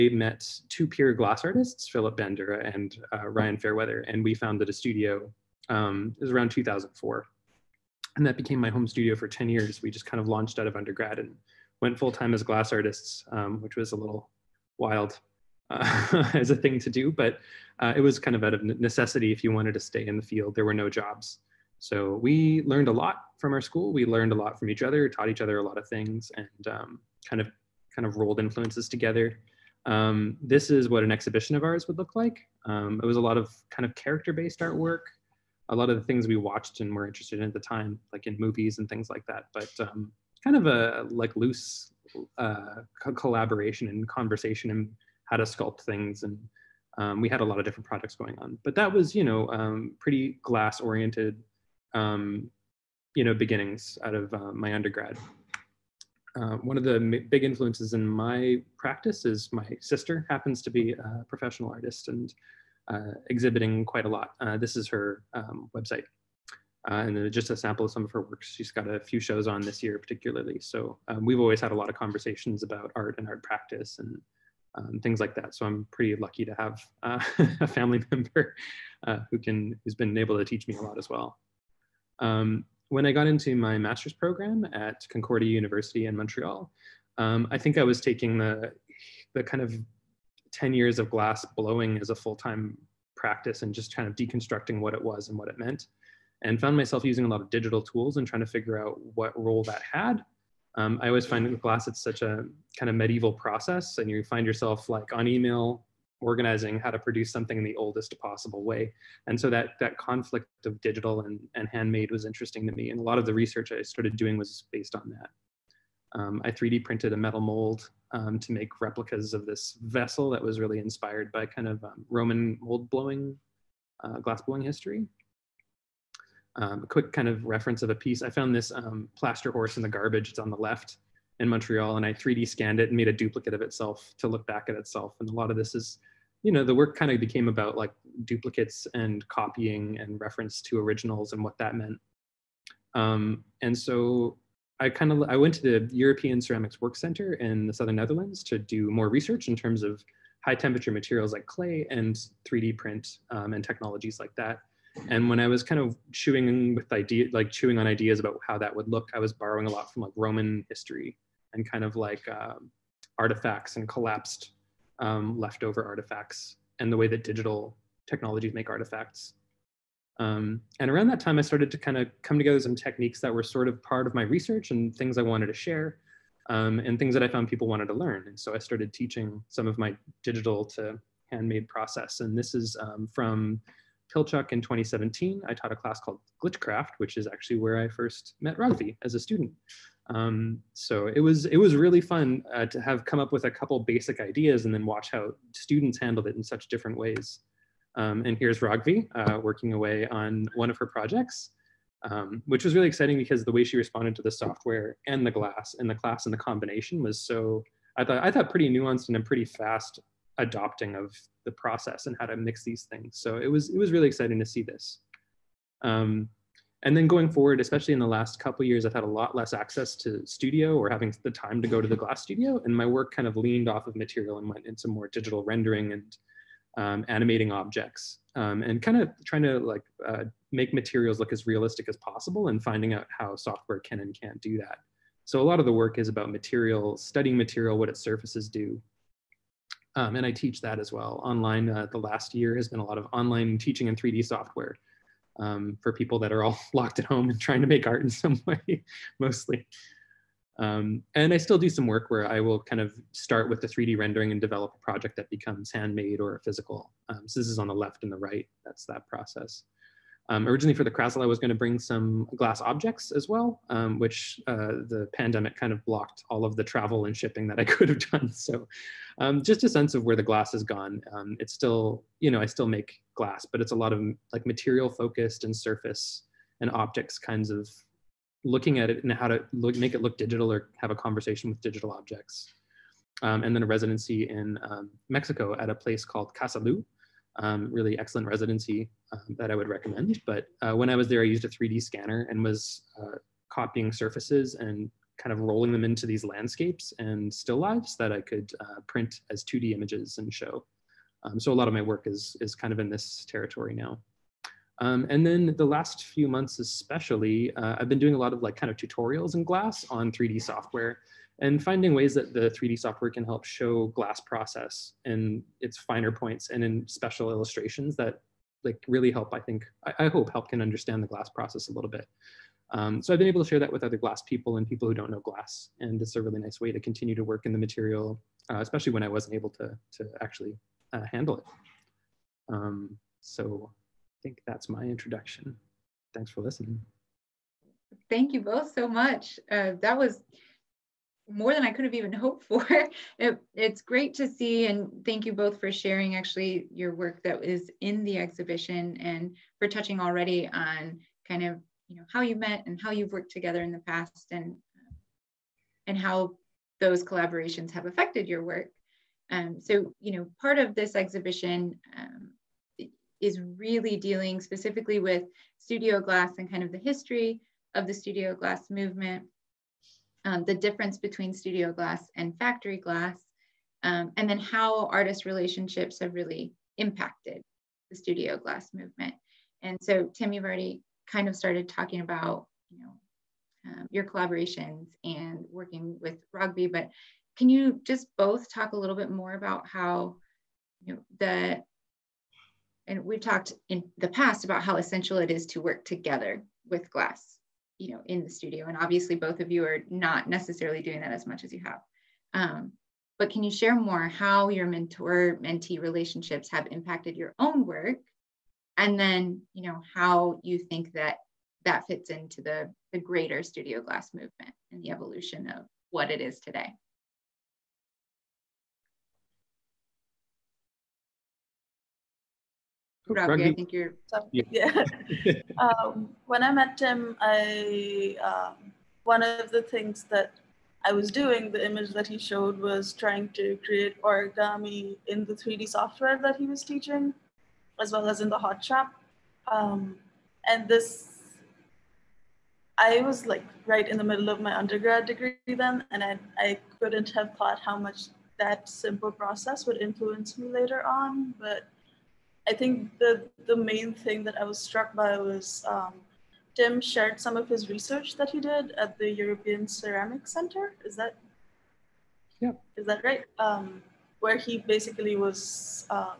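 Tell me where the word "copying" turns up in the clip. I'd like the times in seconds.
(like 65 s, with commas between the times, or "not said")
139 s, 293 s.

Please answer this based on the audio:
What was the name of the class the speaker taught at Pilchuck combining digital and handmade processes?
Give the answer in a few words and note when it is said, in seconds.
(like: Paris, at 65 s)
Glitchcraft, at 186 s.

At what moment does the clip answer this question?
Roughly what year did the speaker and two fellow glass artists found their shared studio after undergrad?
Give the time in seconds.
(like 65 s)
6 s.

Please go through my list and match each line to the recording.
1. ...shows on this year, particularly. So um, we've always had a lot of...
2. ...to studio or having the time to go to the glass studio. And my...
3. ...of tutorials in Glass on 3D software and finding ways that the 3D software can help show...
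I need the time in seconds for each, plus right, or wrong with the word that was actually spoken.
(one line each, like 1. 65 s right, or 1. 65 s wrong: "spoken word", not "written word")
1. 69 s right
2. 219 s right
3. 308 s right.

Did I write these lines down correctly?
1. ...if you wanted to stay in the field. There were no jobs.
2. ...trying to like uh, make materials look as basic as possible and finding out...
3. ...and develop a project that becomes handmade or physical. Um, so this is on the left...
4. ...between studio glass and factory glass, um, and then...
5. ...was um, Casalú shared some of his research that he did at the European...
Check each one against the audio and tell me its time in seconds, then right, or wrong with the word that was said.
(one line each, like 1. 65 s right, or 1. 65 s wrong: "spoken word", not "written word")
1. 19 s right
2. 229 s wrong: "realistic", not "basic"
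3. 254 s right
4. 370 s right
5. 455 s wrong: "Tim", not "Casalú".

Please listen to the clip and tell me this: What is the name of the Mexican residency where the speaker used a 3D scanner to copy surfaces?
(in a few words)
Casalú.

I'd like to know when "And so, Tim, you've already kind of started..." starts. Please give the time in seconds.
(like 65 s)
379 s.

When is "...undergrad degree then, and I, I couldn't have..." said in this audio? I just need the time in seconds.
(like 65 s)
444 s.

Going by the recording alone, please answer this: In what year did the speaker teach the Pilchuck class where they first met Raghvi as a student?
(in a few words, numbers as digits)
2017.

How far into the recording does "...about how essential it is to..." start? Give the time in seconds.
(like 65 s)
394 s.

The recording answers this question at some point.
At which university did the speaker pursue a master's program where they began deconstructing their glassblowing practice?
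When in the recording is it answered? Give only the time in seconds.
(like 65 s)
85 s.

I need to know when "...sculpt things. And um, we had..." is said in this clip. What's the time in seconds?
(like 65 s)
45 s.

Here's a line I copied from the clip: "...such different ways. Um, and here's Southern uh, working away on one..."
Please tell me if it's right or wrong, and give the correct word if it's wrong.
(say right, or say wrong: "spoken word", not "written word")
wrong: "Raghvi", not "Southern".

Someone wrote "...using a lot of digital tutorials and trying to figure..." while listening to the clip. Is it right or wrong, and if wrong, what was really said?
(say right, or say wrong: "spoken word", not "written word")
wrong: "tools", not "tutorials".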